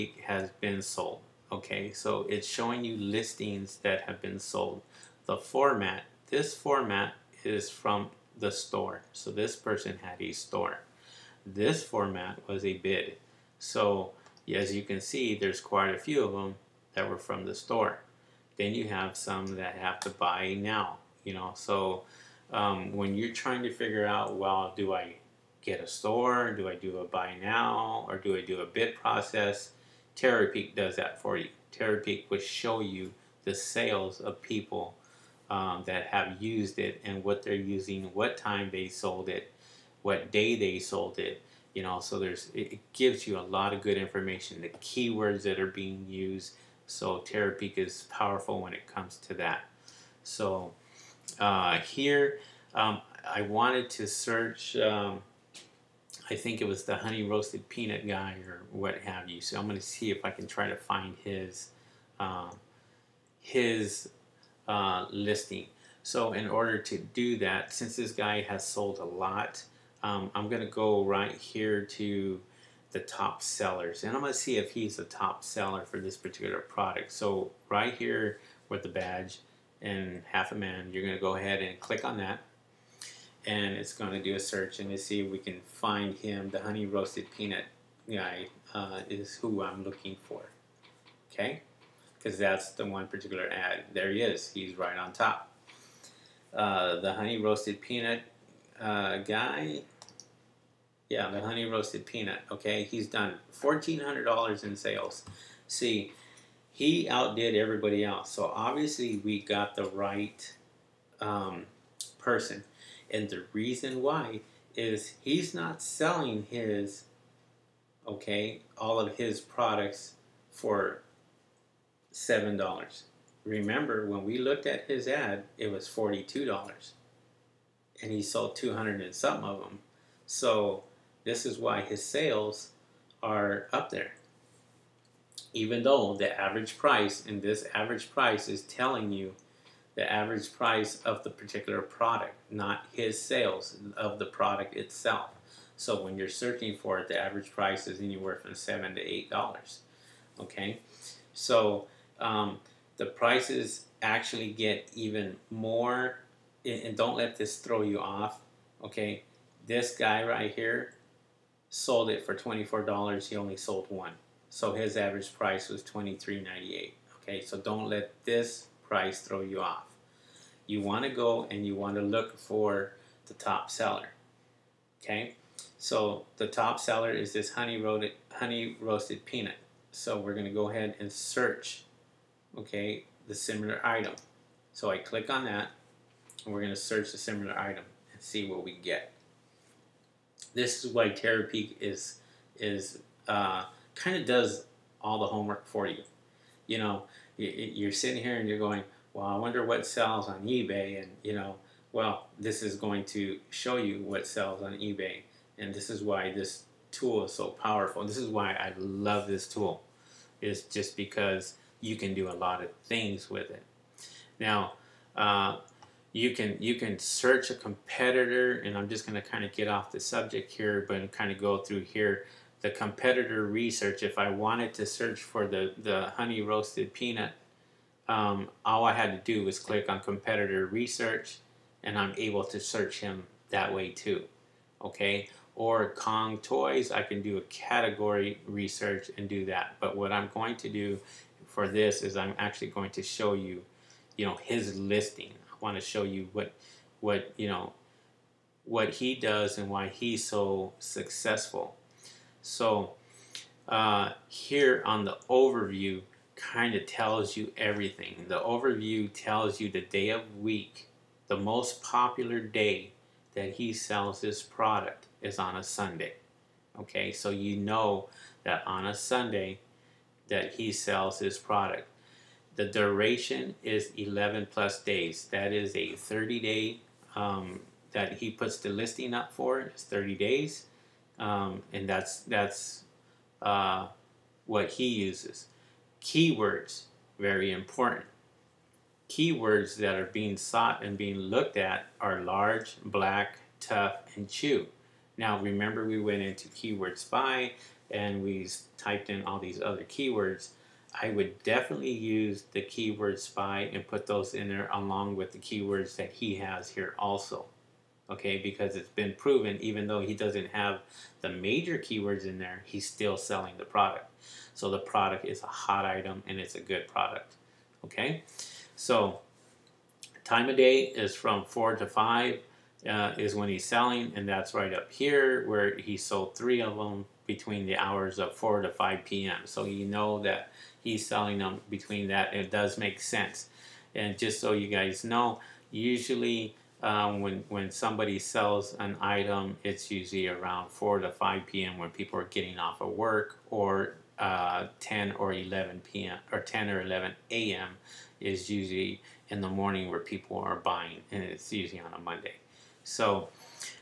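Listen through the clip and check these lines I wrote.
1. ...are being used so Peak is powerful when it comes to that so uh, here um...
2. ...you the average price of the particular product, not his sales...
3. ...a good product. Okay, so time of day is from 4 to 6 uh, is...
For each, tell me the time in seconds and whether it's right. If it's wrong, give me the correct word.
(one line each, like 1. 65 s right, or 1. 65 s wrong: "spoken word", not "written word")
1. 45 s wrong: "Terapeak", not "Peak"
2. 139 s right
3. 316 s wrong: "5", not "6".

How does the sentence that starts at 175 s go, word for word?
So the top seller is this honey roasted, honey roasted peanut.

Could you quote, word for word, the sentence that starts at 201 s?
And, you know, well, this is going to show you what sells on eBay.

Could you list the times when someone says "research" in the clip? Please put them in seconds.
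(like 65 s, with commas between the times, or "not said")
223 s, 230 s, 238 s.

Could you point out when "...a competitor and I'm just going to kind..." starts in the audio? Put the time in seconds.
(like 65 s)
217 s.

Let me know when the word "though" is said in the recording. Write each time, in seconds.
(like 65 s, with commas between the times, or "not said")
135 s, 309 s.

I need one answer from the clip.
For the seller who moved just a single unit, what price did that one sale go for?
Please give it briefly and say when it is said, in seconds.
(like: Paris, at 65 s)
$24, at 162 s.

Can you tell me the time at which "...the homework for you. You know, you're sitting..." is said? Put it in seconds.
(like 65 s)
195 s.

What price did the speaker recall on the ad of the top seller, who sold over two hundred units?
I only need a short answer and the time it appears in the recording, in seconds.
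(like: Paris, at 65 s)
$42, at 125 s.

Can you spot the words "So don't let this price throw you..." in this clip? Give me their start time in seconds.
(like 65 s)
167 s.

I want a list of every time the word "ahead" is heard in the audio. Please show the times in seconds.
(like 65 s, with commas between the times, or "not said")
81 s, 180 s.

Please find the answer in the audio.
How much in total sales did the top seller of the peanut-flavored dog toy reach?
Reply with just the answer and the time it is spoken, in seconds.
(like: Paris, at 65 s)
$1,400, at 103 s.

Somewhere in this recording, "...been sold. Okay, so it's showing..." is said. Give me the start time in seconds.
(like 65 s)
0 s.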